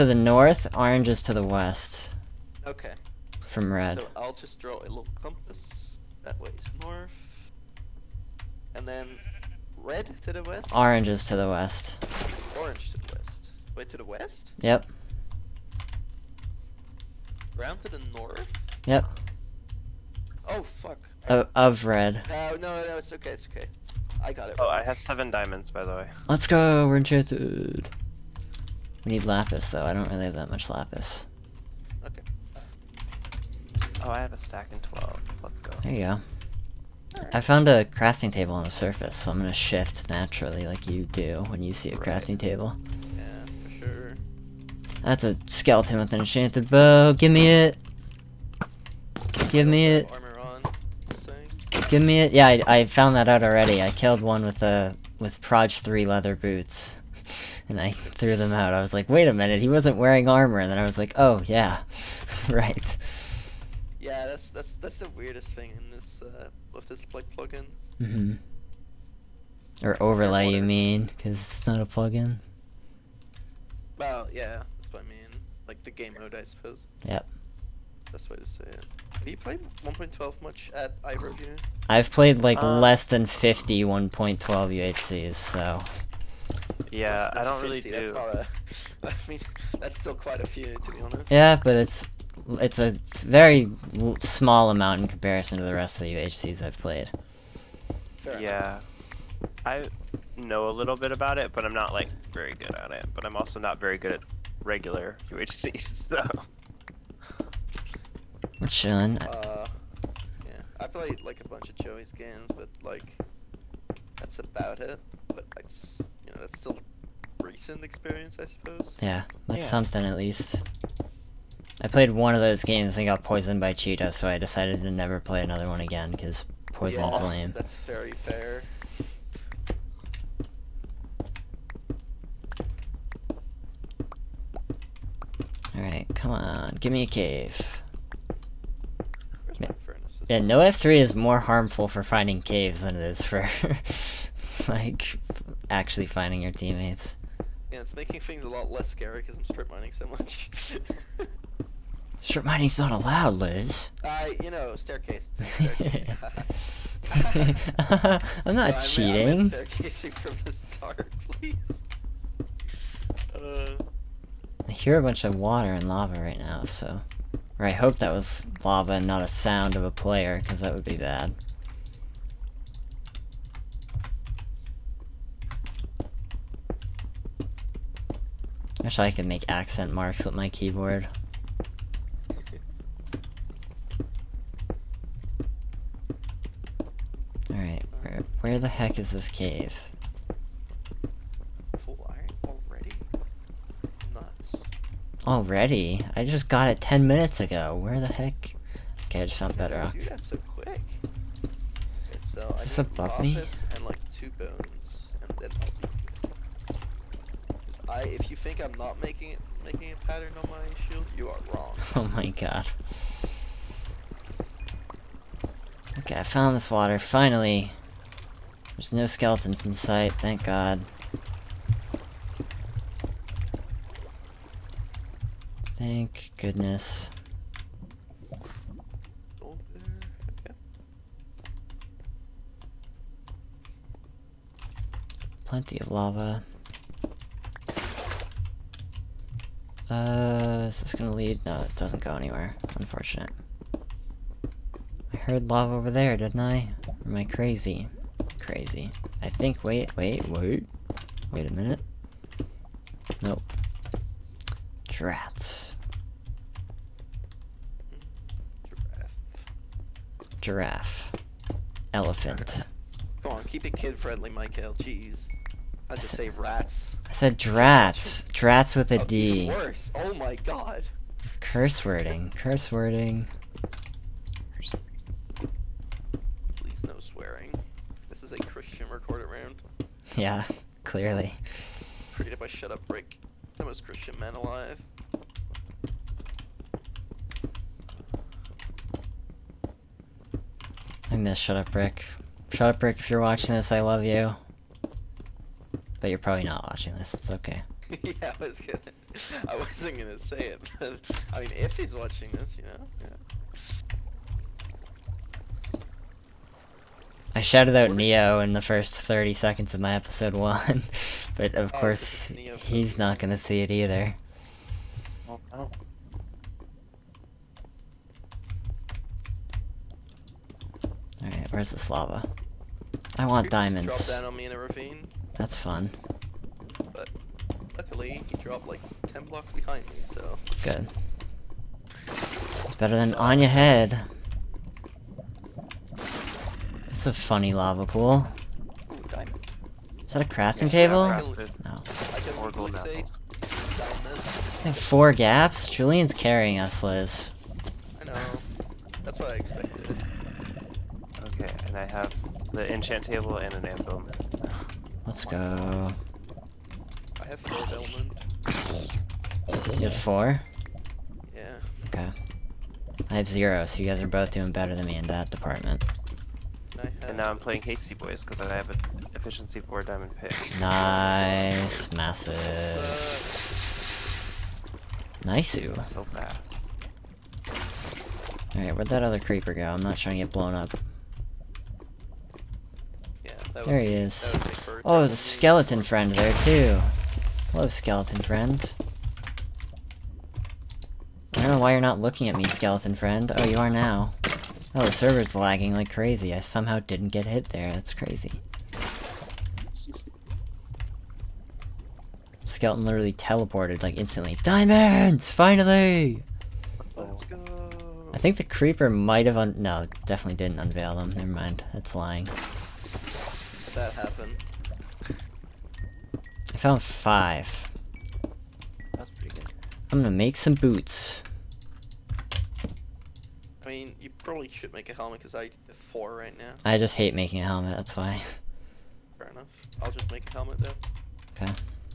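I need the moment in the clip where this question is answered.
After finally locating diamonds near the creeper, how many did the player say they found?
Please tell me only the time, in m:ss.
6:56.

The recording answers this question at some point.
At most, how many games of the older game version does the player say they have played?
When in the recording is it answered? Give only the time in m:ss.
1:22.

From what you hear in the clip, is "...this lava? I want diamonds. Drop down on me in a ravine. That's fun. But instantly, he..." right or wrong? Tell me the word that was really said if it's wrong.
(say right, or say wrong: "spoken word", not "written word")
wrong: "luckily", not "instantly".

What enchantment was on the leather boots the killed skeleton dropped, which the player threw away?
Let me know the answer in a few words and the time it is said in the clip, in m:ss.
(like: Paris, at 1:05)
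Proj 3, at 0:55.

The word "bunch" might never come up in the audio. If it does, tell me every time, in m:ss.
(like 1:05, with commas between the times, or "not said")
1:51, 2:45.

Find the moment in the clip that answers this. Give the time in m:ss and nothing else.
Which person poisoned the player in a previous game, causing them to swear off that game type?
2:03.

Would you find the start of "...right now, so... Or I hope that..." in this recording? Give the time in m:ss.
2:46.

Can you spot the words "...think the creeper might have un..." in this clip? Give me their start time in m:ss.
6:48.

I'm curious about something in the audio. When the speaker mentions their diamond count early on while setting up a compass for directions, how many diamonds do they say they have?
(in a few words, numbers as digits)
7.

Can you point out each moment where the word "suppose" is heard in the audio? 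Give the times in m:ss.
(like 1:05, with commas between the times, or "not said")
1:16, 1:58.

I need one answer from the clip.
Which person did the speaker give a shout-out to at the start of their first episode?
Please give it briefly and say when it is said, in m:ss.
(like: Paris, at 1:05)
Neo, at 5:07.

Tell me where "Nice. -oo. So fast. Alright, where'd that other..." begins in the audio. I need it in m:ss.
6:15.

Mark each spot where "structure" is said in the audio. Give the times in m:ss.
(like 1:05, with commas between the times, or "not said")
not said.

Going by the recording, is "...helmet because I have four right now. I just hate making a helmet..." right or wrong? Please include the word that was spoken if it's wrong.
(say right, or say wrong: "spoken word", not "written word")
right.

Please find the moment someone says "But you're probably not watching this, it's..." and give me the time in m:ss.
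4:56.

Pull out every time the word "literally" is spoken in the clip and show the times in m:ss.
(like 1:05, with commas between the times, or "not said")
6:42.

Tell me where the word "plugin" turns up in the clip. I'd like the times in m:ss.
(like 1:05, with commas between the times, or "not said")
1:07, 1:11.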